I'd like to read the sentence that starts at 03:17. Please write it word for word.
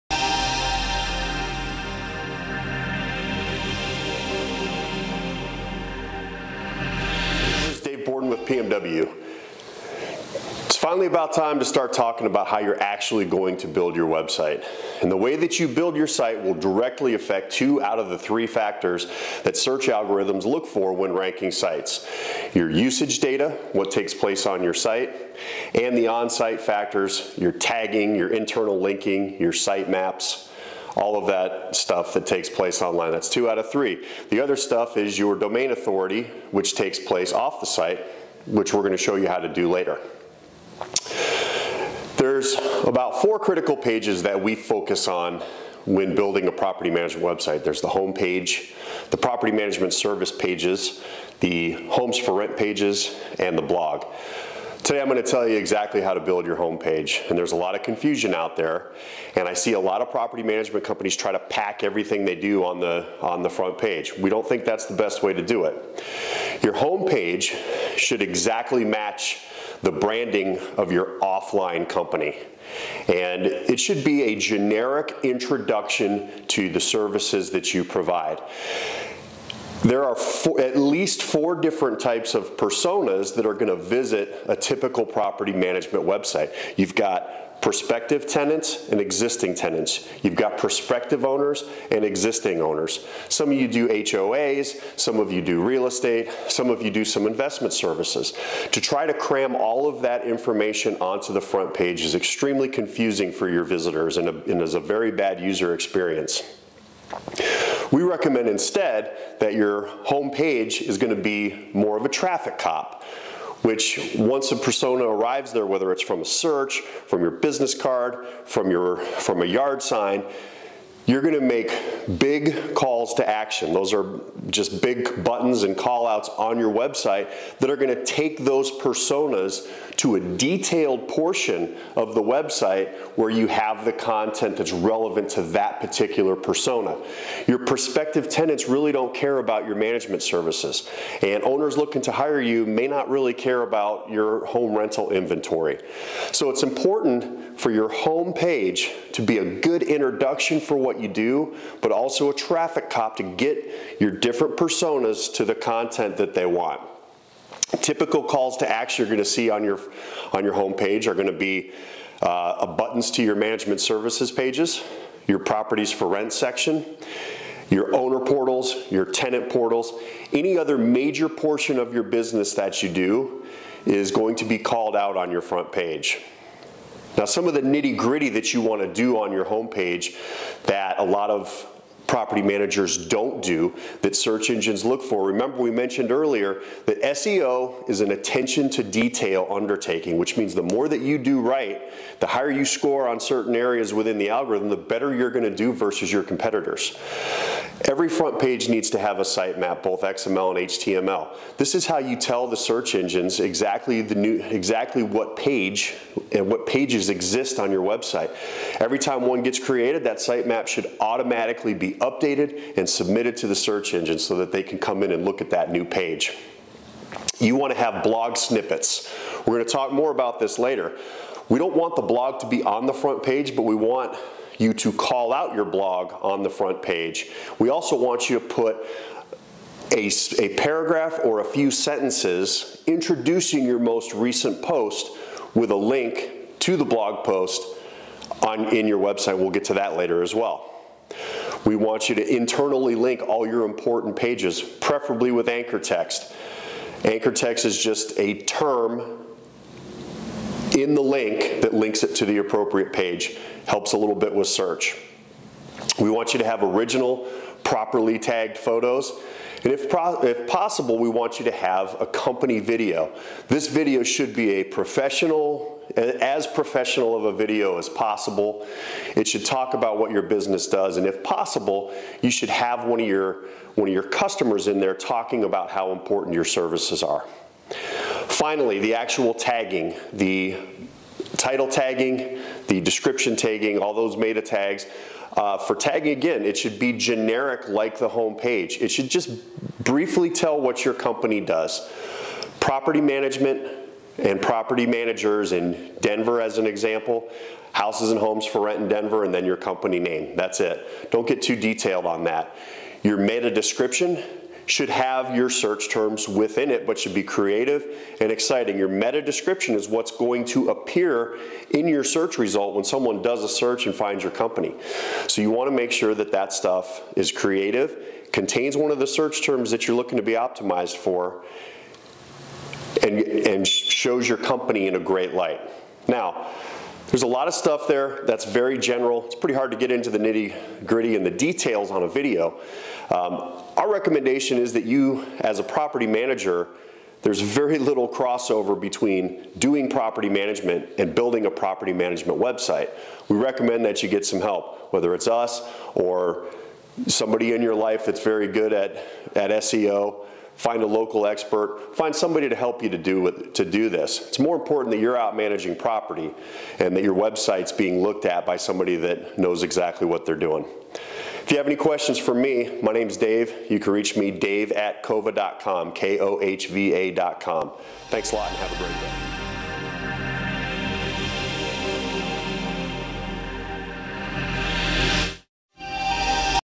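Every front page needs to have a sitemap, both XML and HTML.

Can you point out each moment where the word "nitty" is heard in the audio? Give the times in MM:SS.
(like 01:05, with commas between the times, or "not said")
02:57, 05:30.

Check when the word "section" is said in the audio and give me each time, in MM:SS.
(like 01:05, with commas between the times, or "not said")
02:46.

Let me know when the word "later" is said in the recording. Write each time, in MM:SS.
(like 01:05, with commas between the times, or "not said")
00:39, 03:40, 03:59.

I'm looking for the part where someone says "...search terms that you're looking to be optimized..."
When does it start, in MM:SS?
05:19.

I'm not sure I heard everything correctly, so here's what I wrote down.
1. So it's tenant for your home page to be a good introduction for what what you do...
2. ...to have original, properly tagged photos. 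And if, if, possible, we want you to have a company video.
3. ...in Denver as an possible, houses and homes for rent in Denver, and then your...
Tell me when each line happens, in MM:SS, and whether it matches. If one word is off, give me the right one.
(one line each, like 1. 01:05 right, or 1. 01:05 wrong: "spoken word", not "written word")
1. 02:26 wrong: "important", not "tenant"
2. 04:16 right
3. 04:55 wrong: "example", not "possible".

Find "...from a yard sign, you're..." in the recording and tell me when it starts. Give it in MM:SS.
01:58.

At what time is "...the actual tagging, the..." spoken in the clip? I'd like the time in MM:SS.
04:38.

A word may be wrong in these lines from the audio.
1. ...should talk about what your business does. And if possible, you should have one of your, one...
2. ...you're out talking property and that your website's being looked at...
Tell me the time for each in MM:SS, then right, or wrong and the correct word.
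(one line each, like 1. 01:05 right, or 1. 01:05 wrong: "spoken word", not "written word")
1. 04:29 right
2. 05:55 wrong: "managing", not "talking".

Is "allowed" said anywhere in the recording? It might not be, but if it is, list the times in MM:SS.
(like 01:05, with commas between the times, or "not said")
not said.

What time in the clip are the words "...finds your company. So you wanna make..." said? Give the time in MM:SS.
05:13.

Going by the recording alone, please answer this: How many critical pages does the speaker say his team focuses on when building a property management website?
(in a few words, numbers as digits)
4.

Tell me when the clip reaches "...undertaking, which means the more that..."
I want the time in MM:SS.
03:09.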